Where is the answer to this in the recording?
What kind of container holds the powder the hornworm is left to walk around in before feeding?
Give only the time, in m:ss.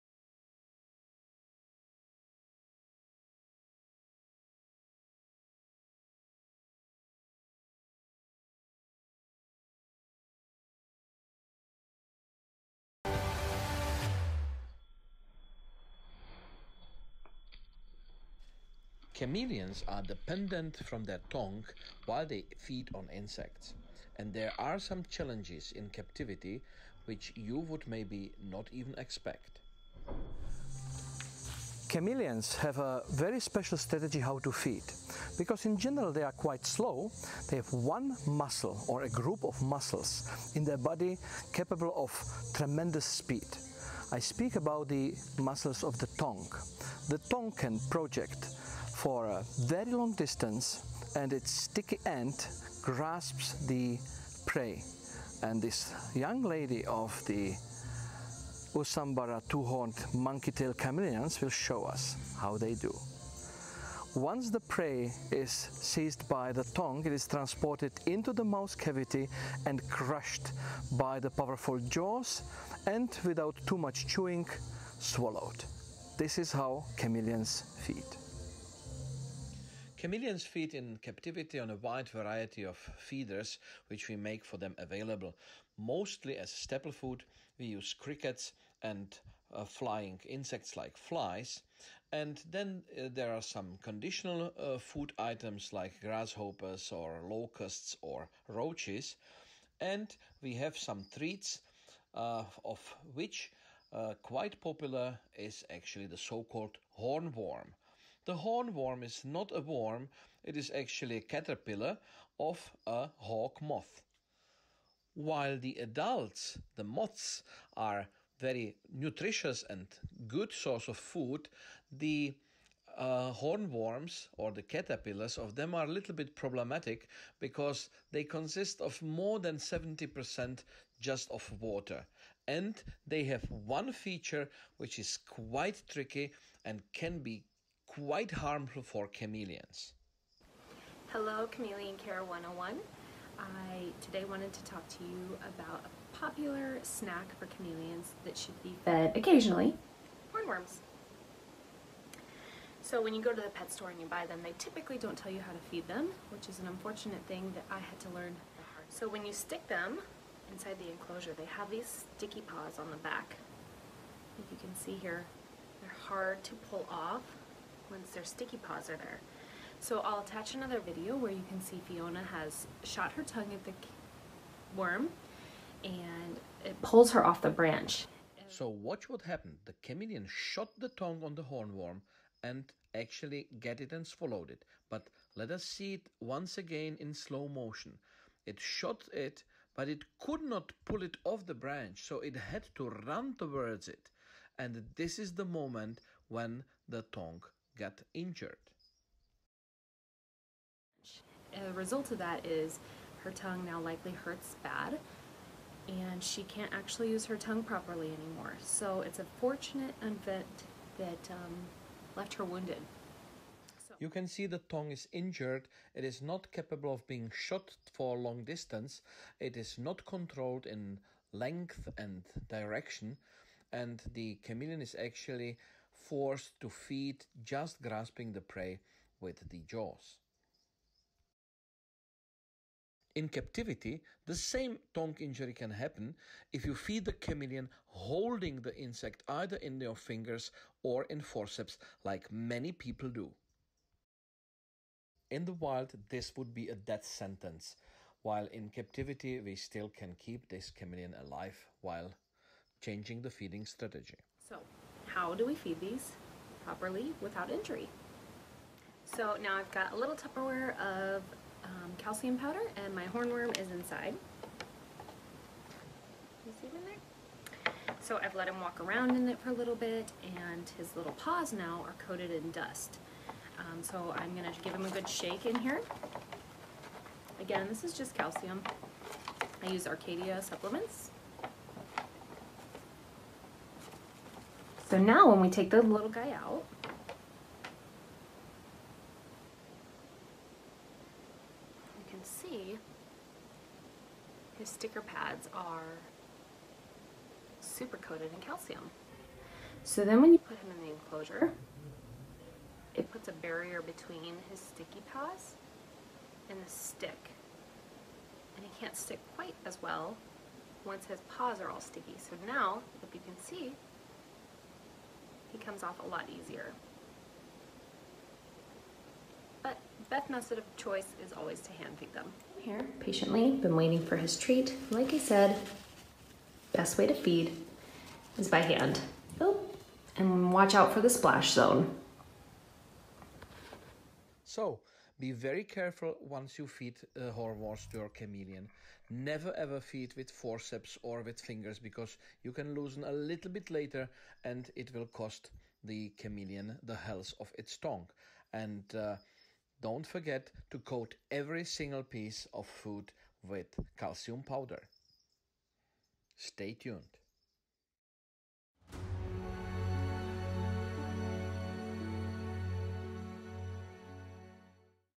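4:20.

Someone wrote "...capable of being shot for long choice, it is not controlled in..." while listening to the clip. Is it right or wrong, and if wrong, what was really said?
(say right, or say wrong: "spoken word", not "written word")
wrong: "distance", not "choice".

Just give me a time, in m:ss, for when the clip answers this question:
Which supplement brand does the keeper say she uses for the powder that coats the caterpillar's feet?
4:39.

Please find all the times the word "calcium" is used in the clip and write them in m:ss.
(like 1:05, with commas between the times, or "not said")
4:21, 4:38, 4:58, 5:53.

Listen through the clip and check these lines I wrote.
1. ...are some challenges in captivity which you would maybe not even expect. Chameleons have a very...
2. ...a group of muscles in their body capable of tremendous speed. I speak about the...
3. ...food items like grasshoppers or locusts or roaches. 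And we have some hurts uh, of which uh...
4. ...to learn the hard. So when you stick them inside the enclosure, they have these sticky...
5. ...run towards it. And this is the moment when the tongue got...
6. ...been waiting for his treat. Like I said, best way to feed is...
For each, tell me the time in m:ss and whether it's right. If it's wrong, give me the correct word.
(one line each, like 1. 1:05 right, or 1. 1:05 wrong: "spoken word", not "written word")
1. 0:24 right
2. 0:39 right
3. 1:34 wrong: "treats", not "hurts"
4. 2:37 right
5. 3:13 right
6. 5:23 right.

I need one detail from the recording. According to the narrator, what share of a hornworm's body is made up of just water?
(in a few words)
More than 70%.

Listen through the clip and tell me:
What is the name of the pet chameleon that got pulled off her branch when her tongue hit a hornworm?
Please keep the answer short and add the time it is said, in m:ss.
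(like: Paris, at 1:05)
Fiona, at 2:51.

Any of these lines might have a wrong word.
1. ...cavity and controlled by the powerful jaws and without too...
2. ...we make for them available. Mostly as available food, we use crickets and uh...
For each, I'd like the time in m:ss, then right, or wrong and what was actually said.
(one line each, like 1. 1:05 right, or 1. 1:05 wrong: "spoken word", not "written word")
1. 1:08 wrong: "crushed", not "controlled"
2. 1:24 wrong: "staple", not "available".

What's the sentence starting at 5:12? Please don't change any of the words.
So now, if you can see, he comes off a lot easier.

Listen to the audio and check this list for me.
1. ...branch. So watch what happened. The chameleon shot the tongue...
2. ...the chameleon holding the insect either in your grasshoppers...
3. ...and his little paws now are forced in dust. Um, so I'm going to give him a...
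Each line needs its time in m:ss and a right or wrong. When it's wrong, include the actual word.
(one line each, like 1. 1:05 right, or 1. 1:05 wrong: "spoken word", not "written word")
1. 2:57 right
2. 3:57 wrong: "fingers", not "grasshoppers"
3. 4:30 wrong: "coated", not "forced".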